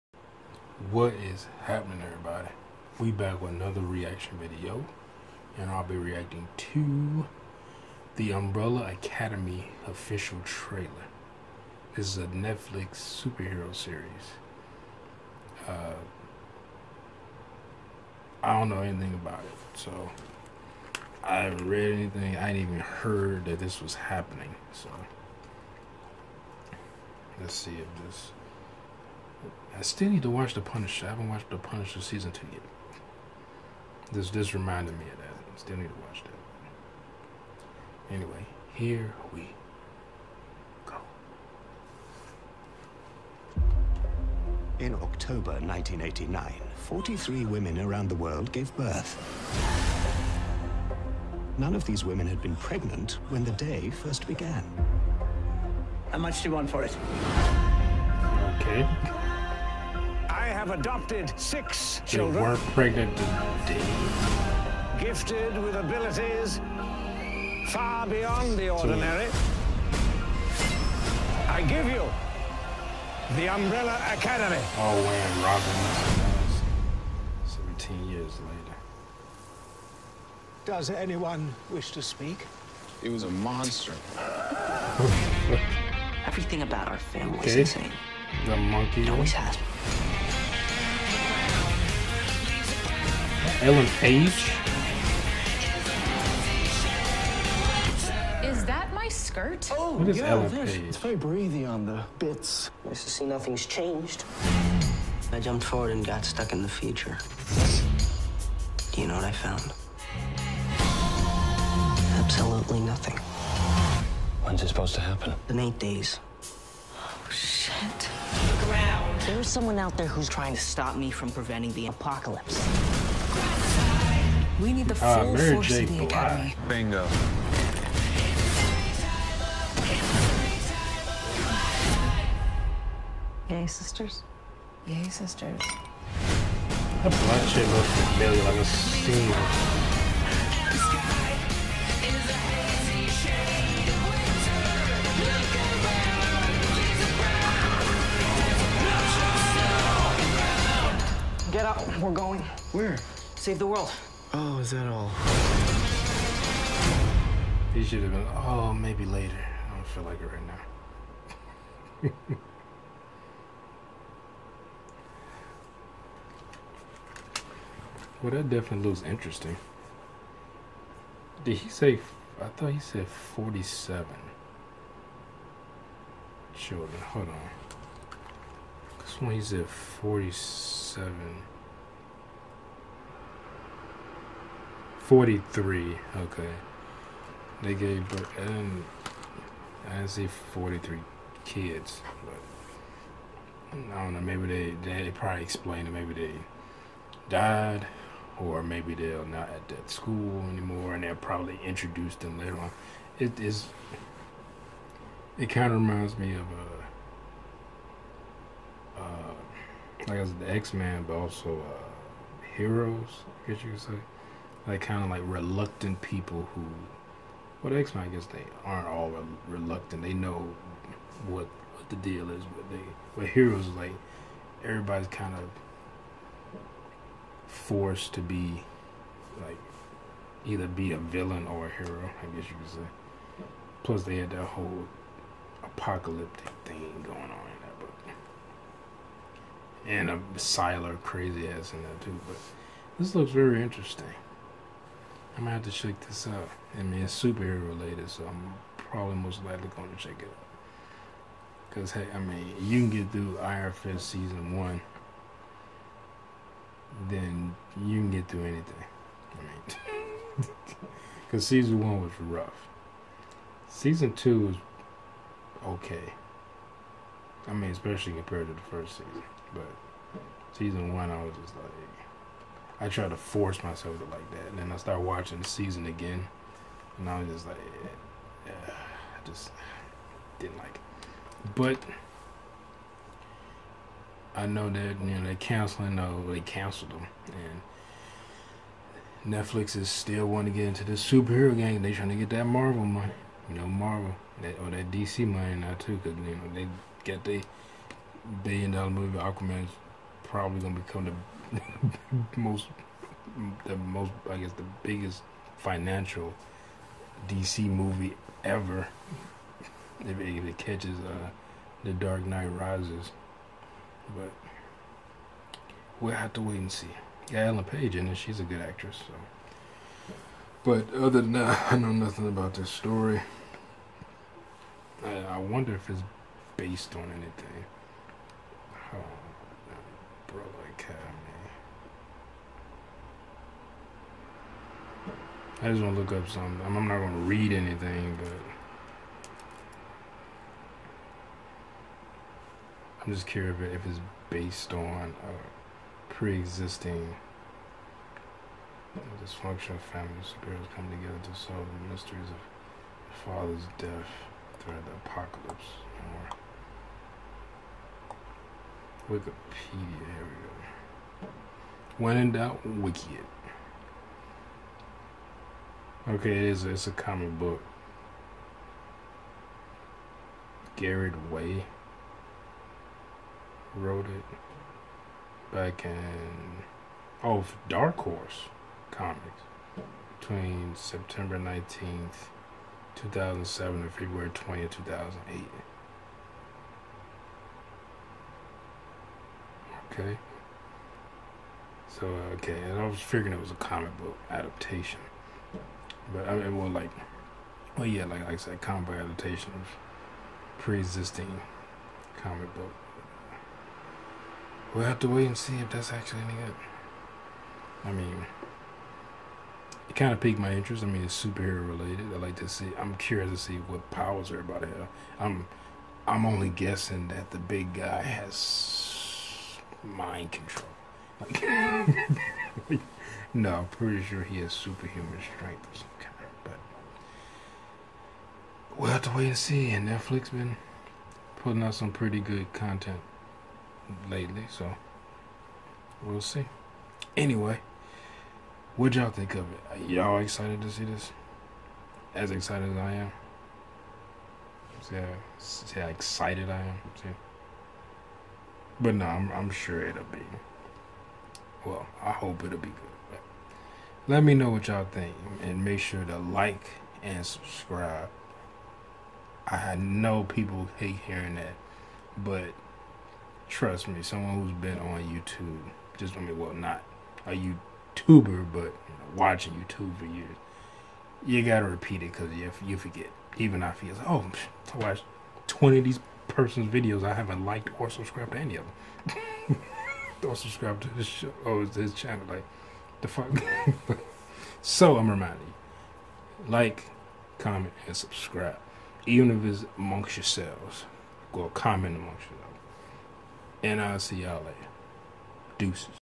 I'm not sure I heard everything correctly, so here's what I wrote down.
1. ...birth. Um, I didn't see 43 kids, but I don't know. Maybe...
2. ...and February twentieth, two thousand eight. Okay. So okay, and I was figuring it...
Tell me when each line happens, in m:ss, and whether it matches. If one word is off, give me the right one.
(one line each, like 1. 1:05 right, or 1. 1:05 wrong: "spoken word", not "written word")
1. 3:08 right
2. 6:23 right.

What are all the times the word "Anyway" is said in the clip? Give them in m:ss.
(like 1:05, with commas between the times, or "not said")
0:38, 7:17.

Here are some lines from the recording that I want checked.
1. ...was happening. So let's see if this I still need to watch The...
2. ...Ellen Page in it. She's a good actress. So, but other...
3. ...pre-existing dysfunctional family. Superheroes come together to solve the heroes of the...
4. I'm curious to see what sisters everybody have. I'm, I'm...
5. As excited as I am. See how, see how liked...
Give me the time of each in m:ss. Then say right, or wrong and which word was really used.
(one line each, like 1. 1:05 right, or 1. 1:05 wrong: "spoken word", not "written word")
1. 0:23 right
2. 5:17 right
3. 5:46 wrong: "mysteries", not "heroes"
4. 6:52 wrong: "powers", not "sisters"
5. 7:22 wrong: "excited", not "liked".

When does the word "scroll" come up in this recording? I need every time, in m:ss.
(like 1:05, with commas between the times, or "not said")
not said.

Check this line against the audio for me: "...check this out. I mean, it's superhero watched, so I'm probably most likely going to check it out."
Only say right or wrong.
wrong.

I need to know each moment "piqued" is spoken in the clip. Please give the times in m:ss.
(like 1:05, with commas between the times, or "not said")
6:50.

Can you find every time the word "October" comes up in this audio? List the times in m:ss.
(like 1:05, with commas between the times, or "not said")
0:44.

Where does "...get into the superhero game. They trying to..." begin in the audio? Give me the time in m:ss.
4:50.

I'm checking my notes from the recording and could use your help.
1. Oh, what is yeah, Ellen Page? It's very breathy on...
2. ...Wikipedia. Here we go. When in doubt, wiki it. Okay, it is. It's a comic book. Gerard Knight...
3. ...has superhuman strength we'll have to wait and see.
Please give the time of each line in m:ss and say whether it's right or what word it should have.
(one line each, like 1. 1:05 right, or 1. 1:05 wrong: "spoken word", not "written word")
1. 1:39 right
2. 5:59 wrong: "Way", not "Knight"
3. 7:04 right.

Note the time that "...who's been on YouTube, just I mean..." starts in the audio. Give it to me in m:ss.
7:44.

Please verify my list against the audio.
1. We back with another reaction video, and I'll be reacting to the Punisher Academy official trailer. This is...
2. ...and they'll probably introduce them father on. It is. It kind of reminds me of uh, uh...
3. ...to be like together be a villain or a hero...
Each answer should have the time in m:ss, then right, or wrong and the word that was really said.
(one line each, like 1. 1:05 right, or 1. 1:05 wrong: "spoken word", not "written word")
1. 0:02 wrong: "Umbrella", not "Punisher"
2. 3:20 wrong: "later", not "father"
3. 3:48 wrong: "either", not "together".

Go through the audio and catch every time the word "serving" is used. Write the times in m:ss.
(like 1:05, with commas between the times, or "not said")
not said.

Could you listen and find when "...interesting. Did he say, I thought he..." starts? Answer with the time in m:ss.
2:49.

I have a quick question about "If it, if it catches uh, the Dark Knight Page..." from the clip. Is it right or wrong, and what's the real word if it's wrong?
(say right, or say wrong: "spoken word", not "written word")
wrong: "Rises", not "Page".